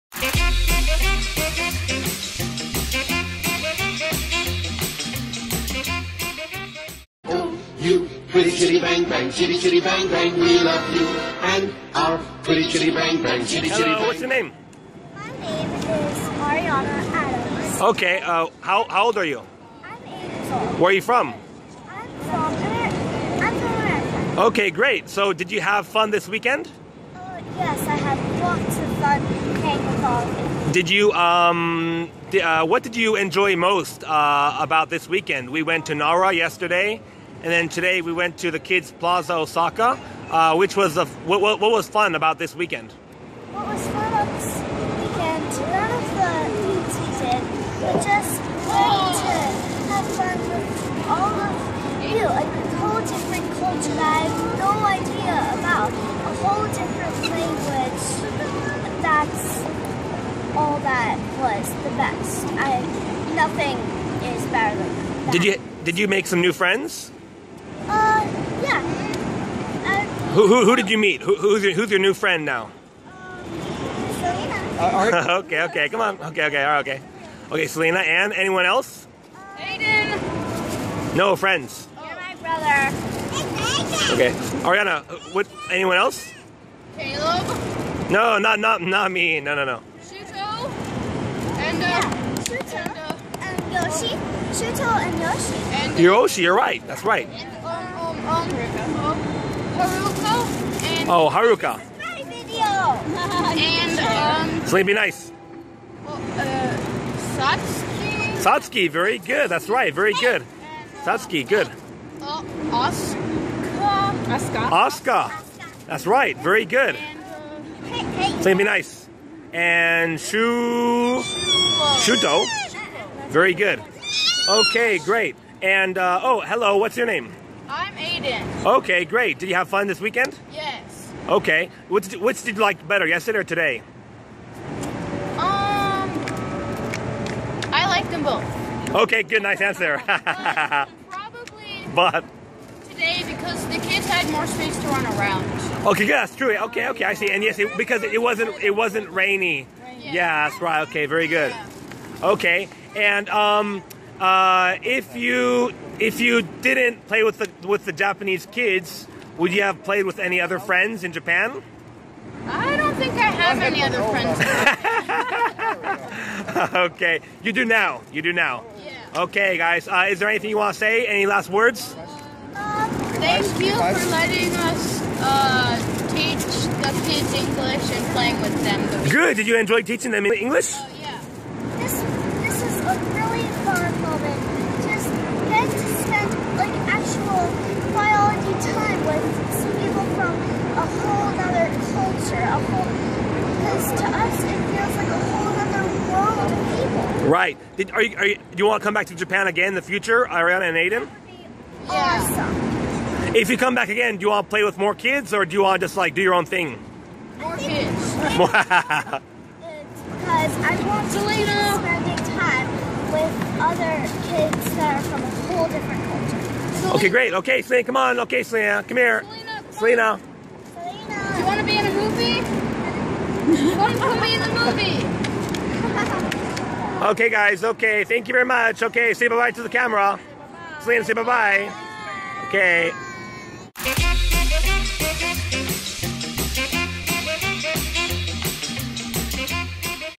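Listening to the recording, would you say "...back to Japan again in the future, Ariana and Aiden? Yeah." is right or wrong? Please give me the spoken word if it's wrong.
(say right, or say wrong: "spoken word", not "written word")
right.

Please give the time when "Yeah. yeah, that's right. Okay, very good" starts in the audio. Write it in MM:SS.
02:29.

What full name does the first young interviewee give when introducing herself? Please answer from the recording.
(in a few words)
Ariana Adams.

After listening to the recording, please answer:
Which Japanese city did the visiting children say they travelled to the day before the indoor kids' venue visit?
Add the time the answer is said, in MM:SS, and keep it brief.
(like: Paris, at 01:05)
Nara, at 00:35.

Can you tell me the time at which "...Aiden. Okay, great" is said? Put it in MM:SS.
02:07.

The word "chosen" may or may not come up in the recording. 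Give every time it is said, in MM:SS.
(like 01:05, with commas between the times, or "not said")
not said.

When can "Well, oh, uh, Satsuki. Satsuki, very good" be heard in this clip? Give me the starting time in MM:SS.
01:46.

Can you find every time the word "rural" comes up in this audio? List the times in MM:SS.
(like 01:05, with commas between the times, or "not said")
not said.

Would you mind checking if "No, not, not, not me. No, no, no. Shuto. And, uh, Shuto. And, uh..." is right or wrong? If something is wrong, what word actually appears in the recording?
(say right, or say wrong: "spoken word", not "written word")
right.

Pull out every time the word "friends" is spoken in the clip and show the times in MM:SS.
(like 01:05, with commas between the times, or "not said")
01:06, 01:12, 01:21, 02:40, 02:46.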